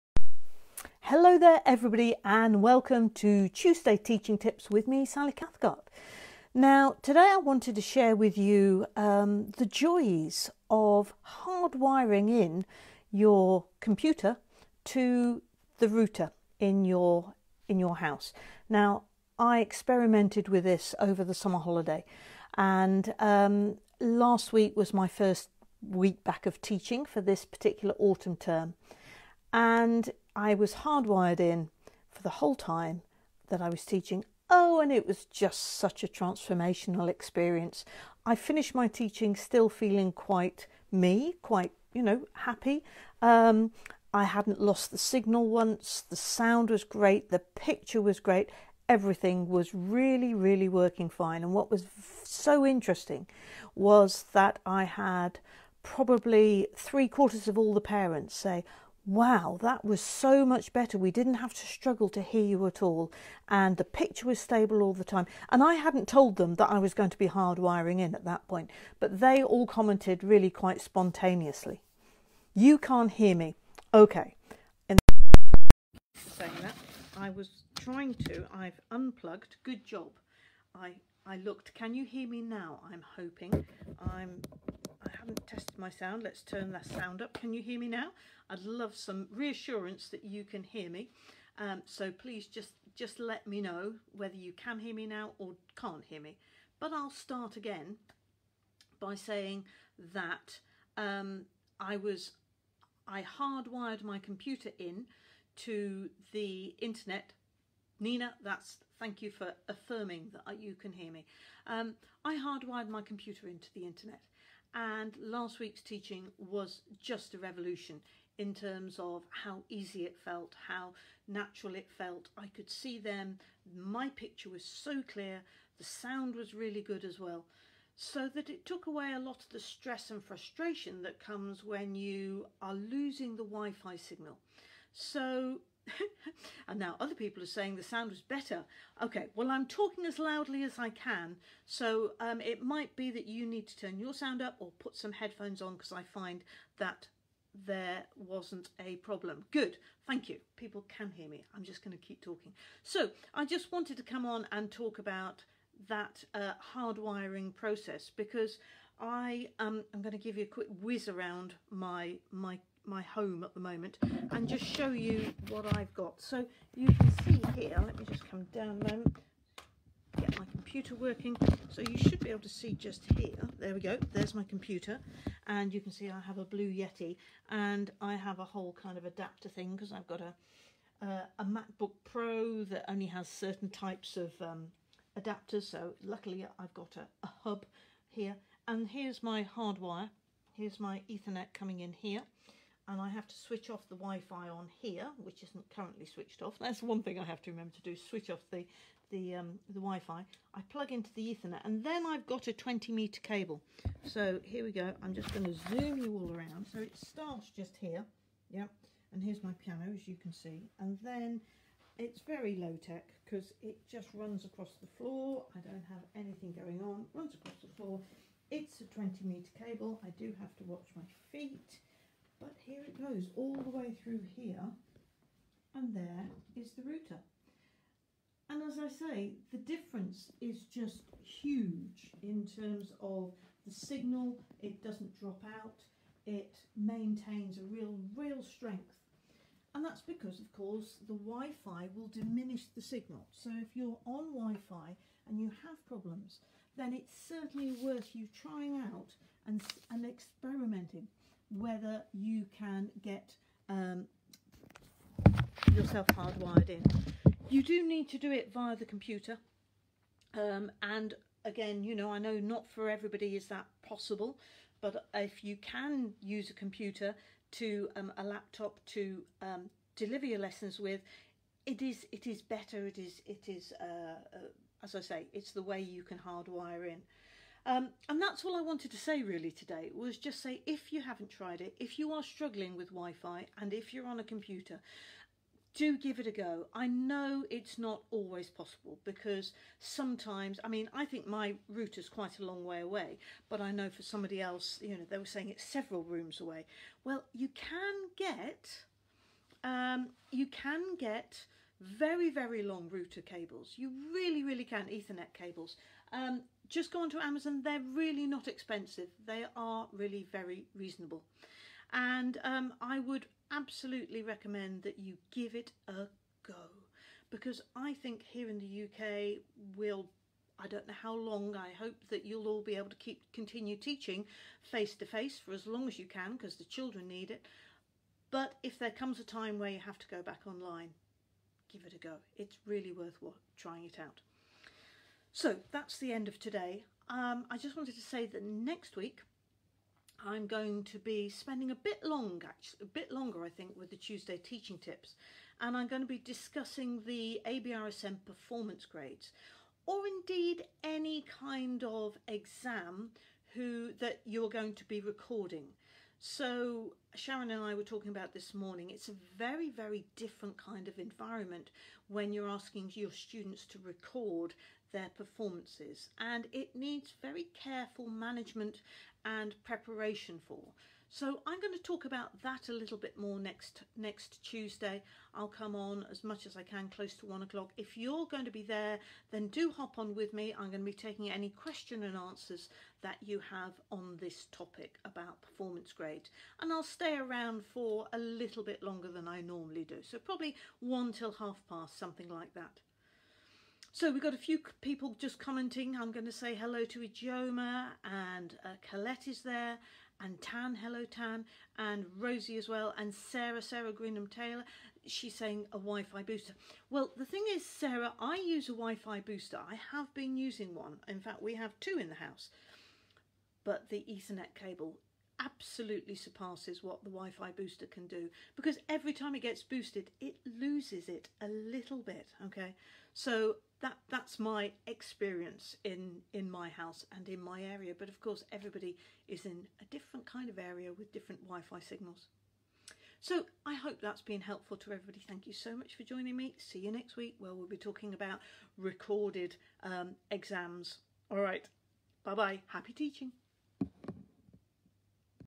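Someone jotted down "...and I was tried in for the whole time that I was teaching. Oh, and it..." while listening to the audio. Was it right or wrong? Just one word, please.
wrong.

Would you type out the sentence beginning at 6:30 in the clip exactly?
So probably one till half past, something like that.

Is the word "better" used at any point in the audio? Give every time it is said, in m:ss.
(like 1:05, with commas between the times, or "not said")
1:00, 2:18, 4:32.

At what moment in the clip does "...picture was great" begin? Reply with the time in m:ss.
0:47.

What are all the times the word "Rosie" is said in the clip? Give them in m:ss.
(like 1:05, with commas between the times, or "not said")
6:42.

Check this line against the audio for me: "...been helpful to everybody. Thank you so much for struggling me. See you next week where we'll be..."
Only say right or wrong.
wrong.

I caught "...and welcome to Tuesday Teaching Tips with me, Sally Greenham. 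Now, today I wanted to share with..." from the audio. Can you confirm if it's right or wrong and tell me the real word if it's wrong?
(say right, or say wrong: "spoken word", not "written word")
wrong: "Cathcart", not "Greenham".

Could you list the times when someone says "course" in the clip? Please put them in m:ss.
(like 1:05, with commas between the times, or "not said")
4:00, 7:08.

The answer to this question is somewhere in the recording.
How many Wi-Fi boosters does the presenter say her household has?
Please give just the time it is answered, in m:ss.
6:51.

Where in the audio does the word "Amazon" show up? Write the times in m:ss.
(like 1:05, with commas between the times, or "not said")
5:07.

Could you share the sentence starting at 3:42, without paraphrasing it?
But here it goes all the way through here and there is the router.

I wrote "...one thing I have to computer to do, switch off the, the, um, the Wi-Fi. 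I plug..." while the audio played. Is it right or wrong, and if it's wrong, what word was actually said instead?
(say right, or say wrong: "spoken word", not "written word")
wrong: "remember", not "computer".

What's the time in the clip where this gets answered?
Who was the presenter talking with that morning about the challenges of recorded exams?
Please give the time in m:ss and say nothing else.
5:57.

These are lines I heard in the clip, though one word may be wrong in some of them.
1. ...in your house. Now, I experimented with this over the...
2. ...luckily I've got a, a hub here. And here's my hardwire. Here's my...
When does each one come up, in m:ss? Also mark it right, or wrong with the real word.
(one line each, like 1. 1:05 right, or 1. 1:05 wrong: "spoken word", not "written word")
1. 0:17 right
2. 3:06 right.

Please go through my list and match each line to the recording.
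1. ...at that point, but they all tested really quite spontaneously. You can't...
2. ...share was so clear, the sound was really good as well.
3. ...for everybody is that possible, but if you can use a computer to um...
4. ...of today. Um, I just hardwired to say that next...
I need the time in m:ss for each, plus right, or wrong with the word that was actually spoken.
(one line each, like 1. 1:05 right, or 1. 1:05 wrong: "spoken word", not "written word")
1. 1:08 wrong: "commented", not "tested"
2. 2:04 wrong: "picture", not "share"
3. 4:22 right
4. 5:36 wrong: "wanted", not "hardwired".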